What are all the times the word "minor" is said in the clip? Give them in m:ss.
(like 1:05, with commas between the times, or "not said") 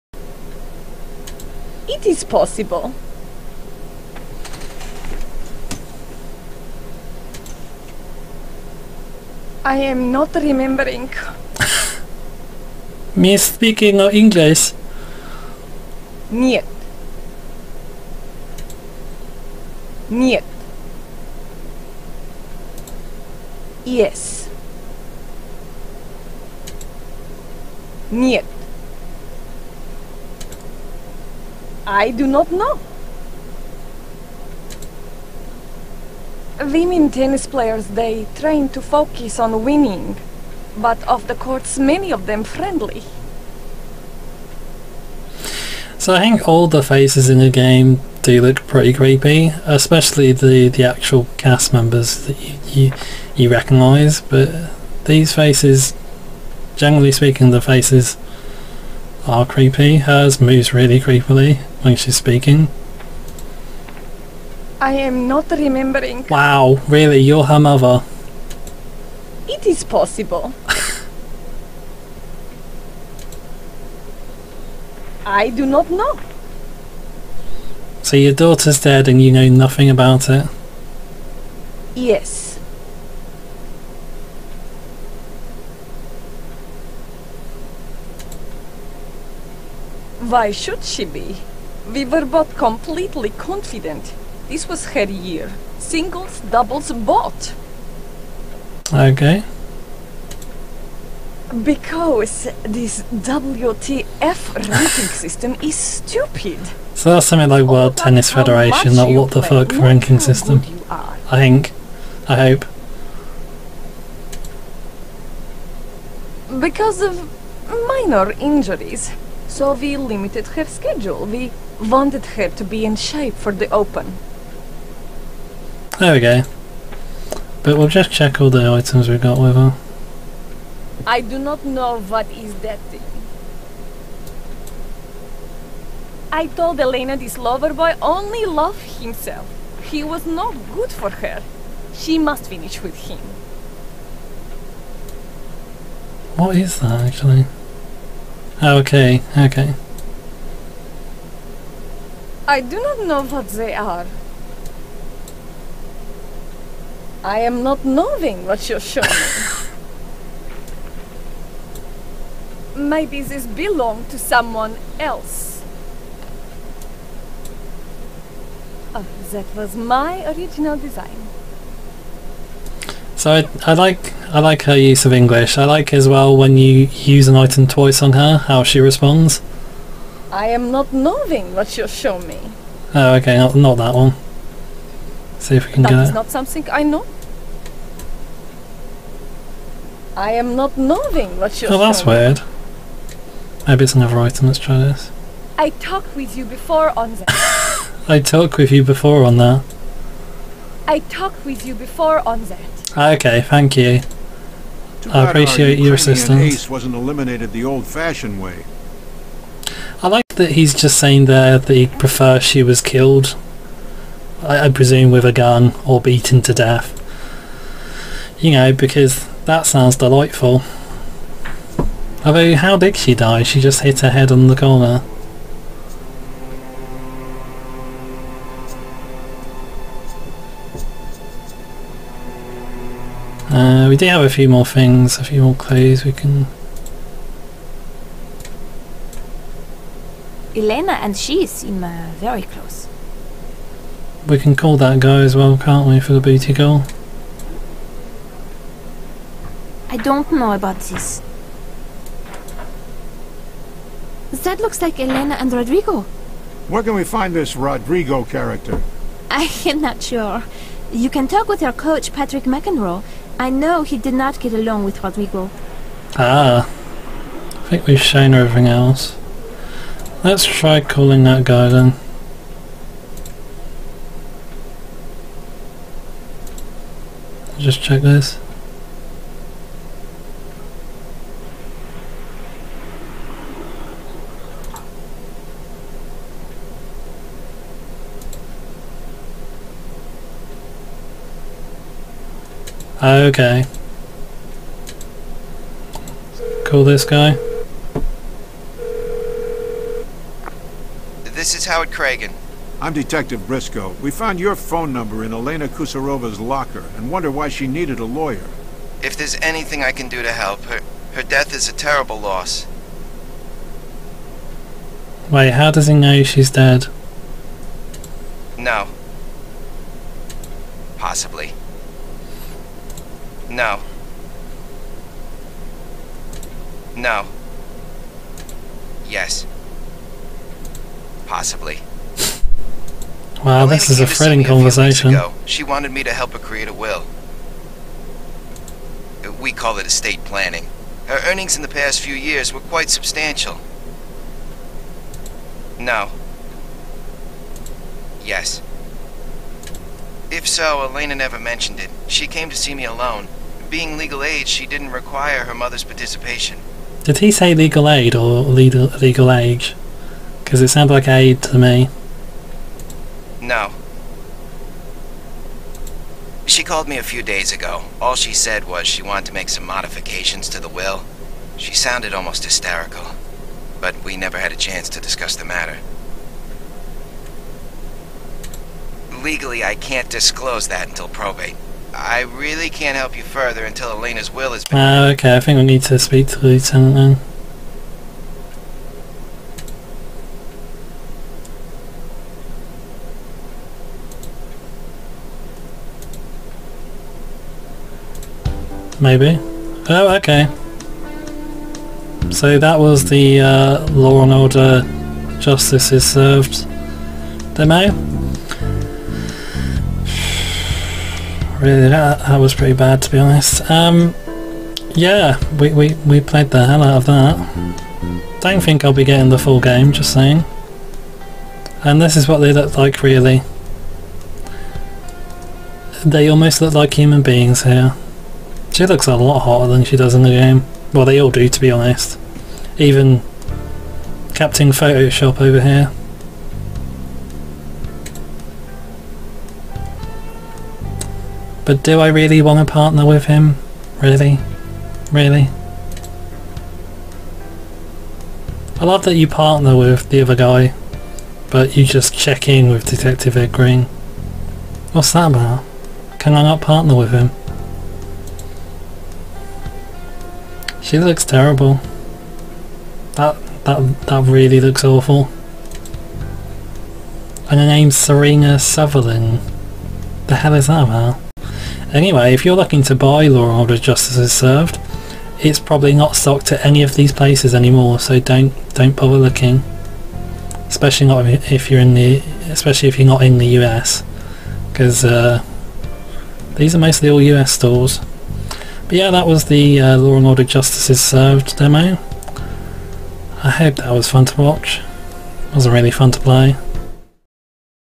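1:57.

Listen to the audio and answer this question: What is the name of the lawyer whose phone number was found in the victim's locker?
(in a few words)
Howard Cragen.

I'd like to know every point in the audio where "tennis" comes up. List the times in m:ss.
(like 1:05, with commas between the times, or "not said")
0:37, 1:48.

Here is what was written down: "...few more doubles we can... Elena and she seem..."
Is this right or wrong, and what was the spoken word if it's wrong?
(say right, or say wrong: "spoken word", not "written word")
wrong: "clues", not "doubles".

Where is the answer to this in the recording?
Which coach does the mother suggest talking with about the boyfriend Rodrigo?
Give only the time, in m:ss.
4:22.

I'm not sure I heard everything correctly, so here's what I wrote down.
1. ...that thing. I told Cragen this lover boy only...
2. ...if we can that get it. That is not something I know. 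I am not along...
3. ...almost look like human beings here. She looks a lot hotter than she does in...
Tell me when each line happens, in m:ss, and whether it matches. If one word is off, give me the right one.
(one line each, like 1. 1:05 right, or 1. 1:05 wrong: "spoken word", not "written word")
1. 2:12 wrong: "Elena", not "Cragen"
2. 3:05 wrong: "knowing", not "along"
3. 7:06 right.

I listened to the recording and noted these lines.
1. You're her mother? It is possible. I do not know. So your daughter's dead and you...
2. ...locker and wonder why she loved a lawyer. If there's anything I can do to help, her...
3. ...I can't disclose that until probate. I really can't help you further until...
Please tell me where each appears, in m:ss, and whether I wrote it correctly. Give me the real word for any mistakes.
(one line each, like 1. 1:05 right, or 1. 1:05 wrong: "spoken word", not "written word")
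1. 1:07 right
2. 5:06 wrong: "needed", not "loved"
3. 6:19 right.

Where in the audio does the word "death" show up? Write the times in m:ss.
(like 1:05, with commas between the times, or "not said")
3:36, 5:11.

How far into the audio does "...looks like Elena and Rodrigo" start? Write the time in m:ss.
4:14.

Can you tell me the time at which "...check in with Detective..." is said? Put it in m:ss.
7:32.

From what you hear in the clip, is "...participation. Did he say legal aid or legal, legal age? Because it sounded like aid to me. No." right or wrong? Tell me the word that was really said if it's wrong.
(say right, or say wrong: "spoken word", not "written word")
right.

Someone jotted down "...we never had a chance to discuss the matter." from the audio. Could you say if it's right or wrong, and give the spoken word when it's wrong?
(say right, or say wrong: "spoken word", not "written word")
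right.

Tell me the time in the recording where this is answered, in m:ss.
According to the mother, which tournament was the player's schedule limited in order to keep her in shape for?
2:03.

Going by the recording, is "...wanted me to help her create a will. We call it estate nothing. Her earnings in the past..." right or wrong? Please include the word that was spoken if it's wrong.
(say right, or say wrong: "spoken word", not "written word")
wrong: "planning", not "nothing".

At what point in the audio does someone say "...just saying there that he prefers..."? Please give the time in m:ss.
3:30.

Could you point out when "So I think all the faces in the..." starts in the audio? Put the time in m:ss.
0:45.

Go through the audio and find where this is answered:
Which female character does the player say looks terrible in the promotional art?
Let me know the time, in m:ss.
7:47.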